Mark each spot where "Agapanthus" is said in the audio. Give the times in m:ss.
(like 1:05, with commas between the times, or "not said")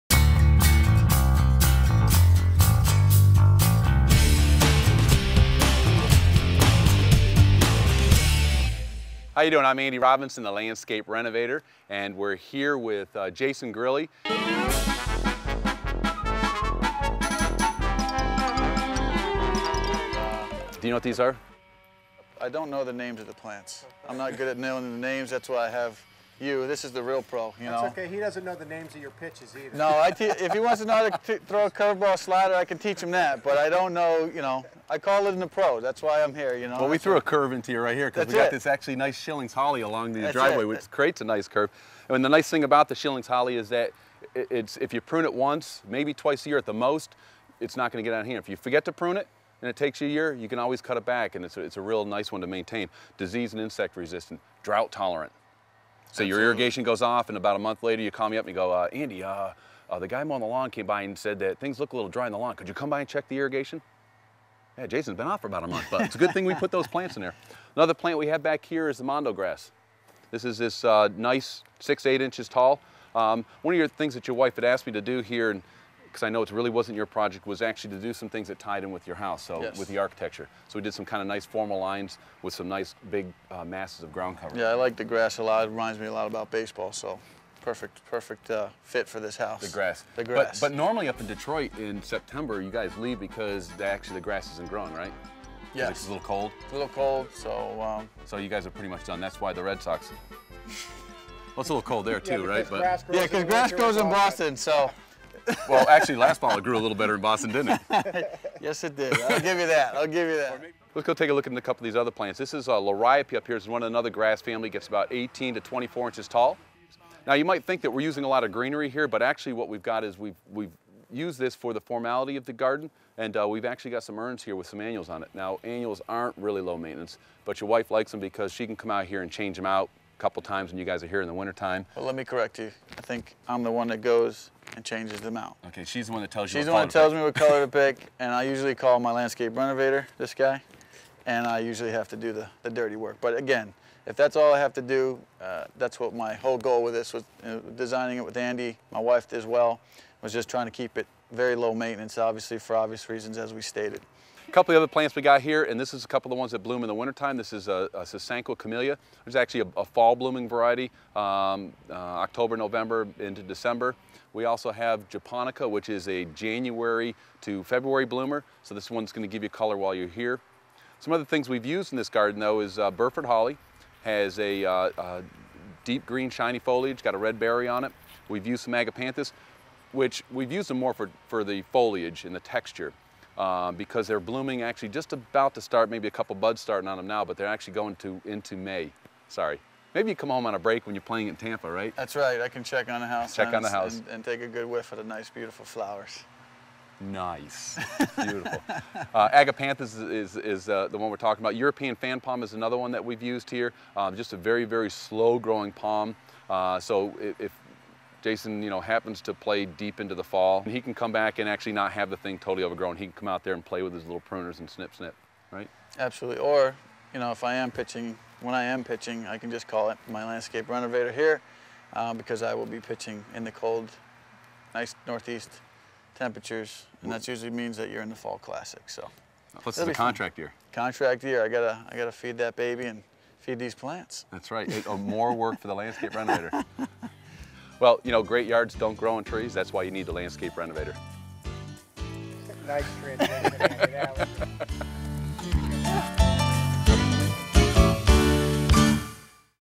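2:58, 3:19.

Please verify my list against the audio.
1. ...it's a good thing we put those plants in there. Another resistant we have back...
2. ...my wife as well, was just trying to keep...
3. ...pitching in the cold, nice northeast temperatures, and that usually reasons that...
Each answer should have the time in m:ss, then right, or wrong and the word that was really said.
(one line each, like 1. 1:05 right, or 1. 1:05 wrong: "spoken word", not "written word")
1. 1:06 wrong: "plant", not "resistant"
2. 2:28 right
3. 3:42 wrong: "means", not "reasons".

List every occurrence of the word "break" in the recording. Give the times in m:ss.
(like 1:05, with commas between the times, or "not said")
3:10.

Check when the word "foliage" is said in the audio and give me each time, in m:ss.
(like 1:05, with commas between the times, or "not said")
2:56, 3:01.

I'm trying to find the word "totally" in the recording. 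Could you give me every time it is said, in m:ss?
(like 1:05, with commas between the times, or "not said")
3:32.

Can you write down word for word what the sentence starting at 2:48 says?
So this one's gonna give you color while you're here.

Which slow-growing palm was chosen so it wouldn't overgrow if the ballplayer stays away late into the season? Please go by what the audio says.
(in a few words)
European fan palm.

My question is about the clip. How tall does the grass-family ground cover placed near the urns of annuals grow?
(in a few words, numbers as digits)
18 to 24 inches.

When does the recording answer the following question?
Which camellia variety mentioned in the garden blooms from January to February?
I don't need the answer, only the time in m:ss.
2:45.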